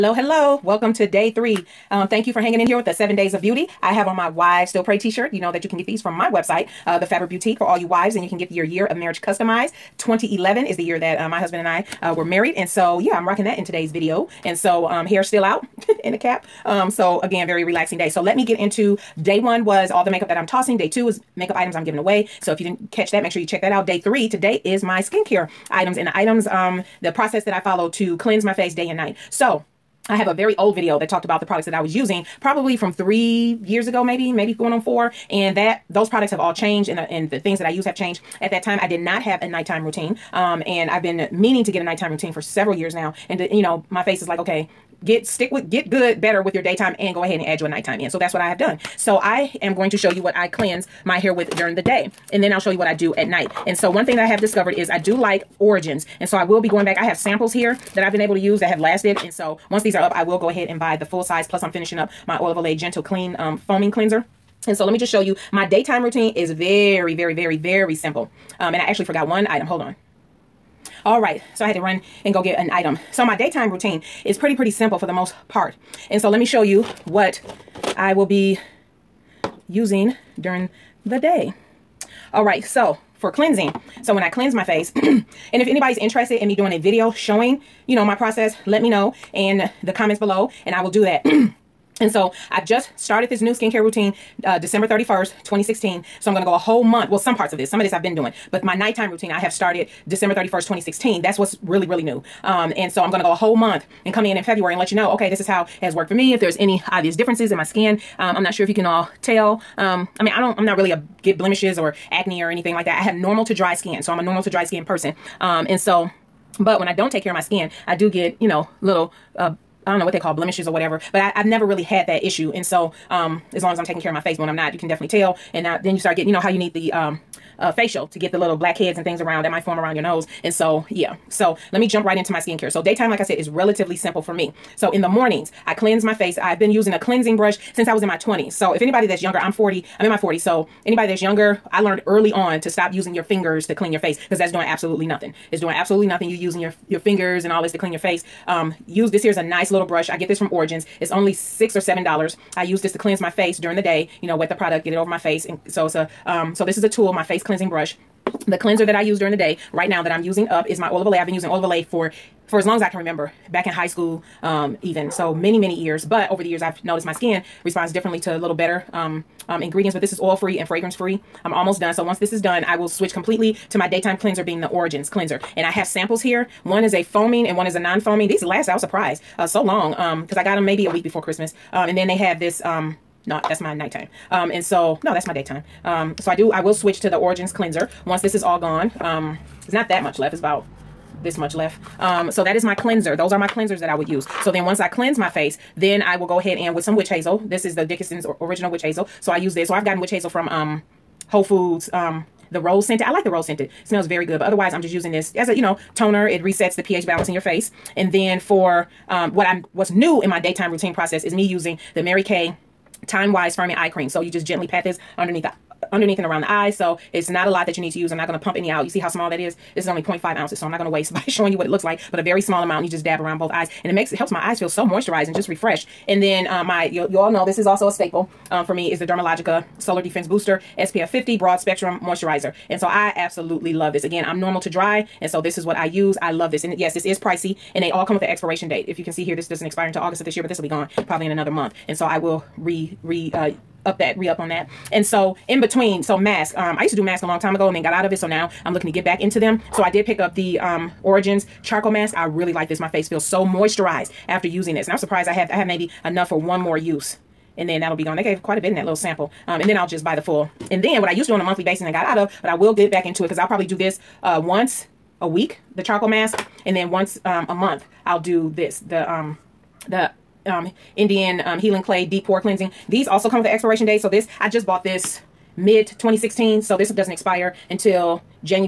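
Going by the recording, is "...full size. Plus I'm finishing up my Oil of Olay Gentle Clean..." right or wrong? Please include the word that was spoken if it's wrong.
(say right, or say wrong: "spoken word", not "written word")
right.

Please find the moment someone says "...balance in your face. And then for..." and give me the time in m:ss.
3:27.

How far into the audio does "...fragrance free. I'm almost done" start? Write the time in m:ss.
2:50.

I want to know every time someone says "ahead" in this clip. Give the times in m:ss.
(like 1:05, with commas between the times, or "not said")
0:47, 1:00, 3:16.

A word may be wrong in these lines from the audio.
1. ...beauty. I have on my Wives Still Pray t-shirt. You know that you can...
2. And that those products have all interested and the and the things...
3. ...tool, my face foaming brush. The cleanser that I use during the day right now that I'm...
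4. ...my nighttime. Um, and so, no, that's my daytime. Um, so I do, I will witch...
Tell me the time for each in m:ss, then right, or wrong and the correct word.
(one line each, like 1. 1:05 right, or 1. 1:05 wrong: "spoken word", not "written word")
1. 0:03 right
2. 0:35 wrong: "changed", not "interested"
3. 2:36 wrong: "cleansing", not "foaming"
4. 3:03 wrong: "switch", not "witch".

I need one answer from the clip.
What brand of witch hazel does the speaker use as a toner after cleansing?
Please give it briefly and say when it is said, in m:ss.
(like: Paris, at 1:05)
Dickinson's, at 3:17.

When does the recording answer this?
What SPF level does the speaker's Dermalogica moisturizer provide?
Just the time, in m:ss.
3:50.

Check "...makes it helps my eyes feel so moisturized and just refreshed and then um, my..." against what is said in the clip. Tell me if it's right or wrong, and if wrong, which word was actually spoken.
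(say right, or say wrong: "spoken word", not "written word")
right.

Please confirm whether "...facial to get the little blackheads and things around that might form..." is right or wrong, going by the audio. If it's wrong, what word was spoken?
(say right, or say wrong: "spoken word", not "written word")
right.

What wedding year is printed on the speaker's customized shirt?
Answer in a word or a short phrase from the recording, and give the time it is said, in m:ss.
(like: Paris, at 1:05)
2011, at 0:09.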